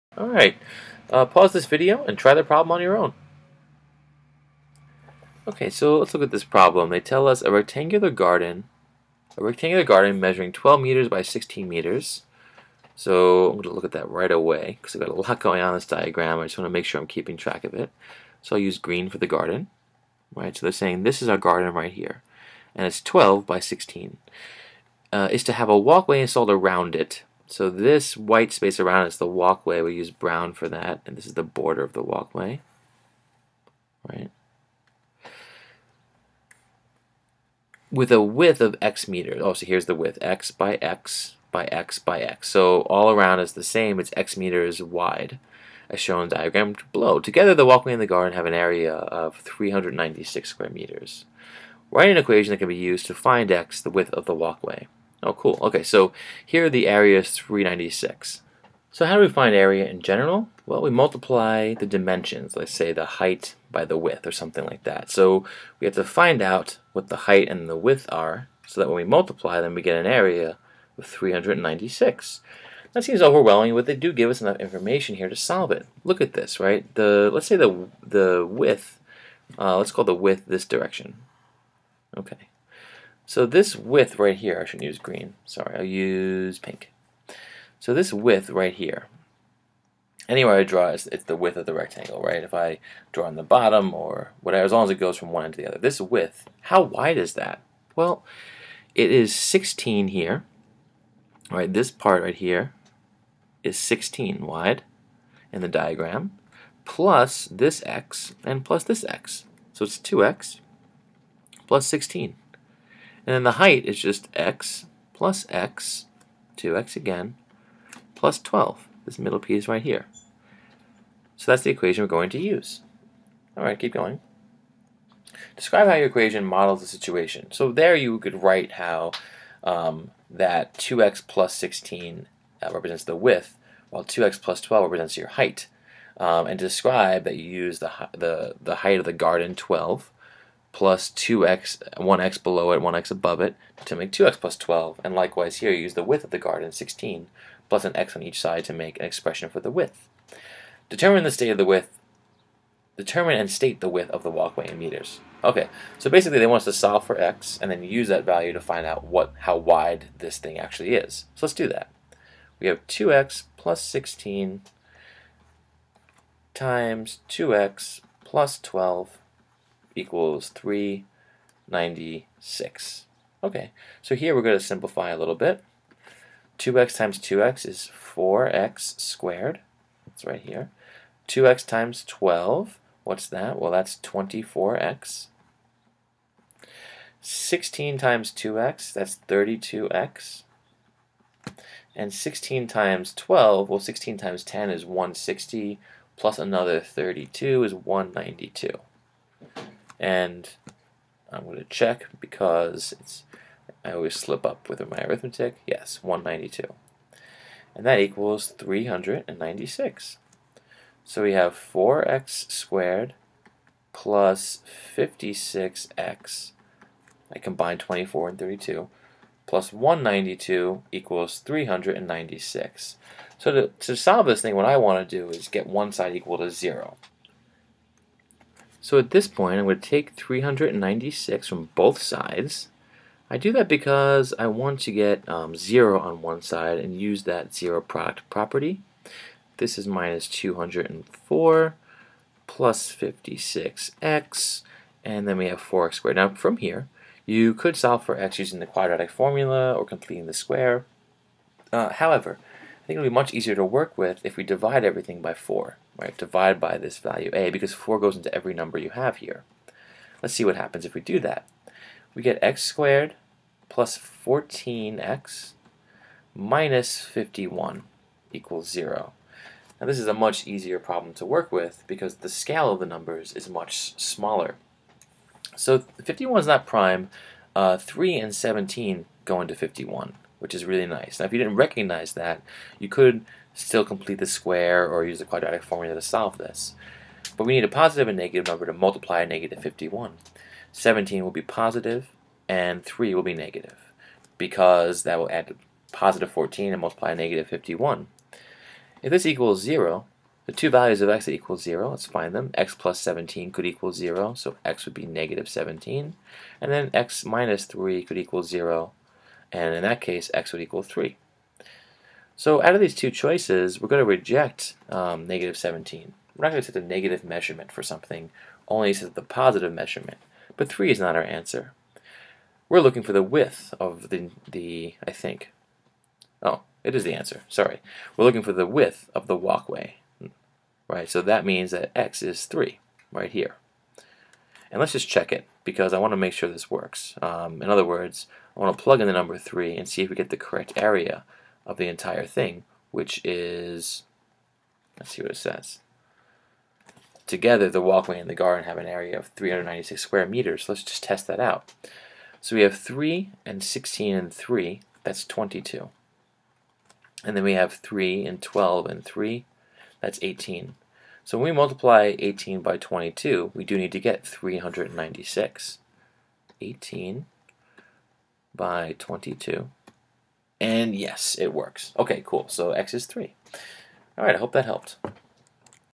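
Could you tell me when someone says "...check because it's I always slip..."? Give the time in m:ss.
3:21.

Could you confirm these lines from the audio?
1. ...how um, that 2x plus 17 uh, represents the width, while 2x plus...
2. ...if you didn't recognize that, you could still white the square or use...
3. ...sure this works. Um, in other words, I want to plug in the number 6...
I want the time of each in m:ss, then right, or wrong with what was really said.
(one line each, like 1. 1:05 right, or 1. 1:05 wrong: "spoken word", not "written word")
1. 2:08 wrong: "16", not "17"
2. 4:41 wrong: "complete", not "white"
3. 5:36 wrong: "3", not "6".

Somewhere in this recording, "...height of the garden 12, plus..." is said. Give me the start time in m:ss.
2:18.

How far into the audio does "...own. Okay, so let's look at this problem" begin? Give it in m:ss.
0:02.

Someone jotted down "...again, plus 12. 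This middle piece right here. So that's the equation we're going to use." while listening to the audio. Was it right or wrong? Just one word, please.
right.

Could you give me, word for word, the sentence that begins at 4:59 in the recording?
If this equals 0, the two values of x that equal 0, let's find them.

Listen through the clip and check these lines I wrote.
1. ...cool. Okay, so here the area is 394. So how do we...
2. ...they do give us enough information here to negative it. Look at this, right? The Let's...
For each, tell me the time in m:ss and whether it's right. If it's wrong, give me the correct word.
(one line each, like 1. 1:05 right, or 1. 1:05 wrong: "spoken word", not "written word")
1. 0:55 wrong: "396", not "394"
2. 1:13 wrong: "solve", not "negative".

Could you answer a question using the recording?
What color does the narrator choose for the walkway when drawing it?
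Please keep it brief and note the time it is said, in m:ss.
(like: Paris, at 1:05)
brown, at 0:30.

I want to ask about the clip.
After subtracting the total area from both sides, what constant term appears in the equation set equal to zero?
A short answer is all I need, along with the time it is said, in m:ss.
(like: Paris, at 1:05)
-204, at 3:59.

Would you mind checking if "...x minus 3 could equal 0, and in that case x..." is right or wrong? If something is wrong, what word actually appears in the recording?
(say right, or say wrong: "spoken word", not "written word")
right.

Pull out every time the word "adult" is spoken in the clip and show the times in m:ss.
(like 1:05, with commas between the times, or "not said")
not said.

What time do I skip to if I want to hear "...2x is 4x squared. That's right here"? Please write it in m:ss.
2:57.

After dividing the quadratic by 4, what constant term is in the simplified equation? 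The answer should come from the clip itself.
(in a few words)
-51.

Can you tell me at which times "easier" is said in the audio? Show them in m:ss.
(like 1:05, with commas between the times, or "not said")
4:13, 4:30.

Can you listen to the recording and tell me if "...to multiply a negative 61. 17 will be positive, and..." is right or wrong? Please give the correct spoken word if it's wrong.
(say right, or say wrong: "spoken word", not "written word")
wrong: "51", not "61".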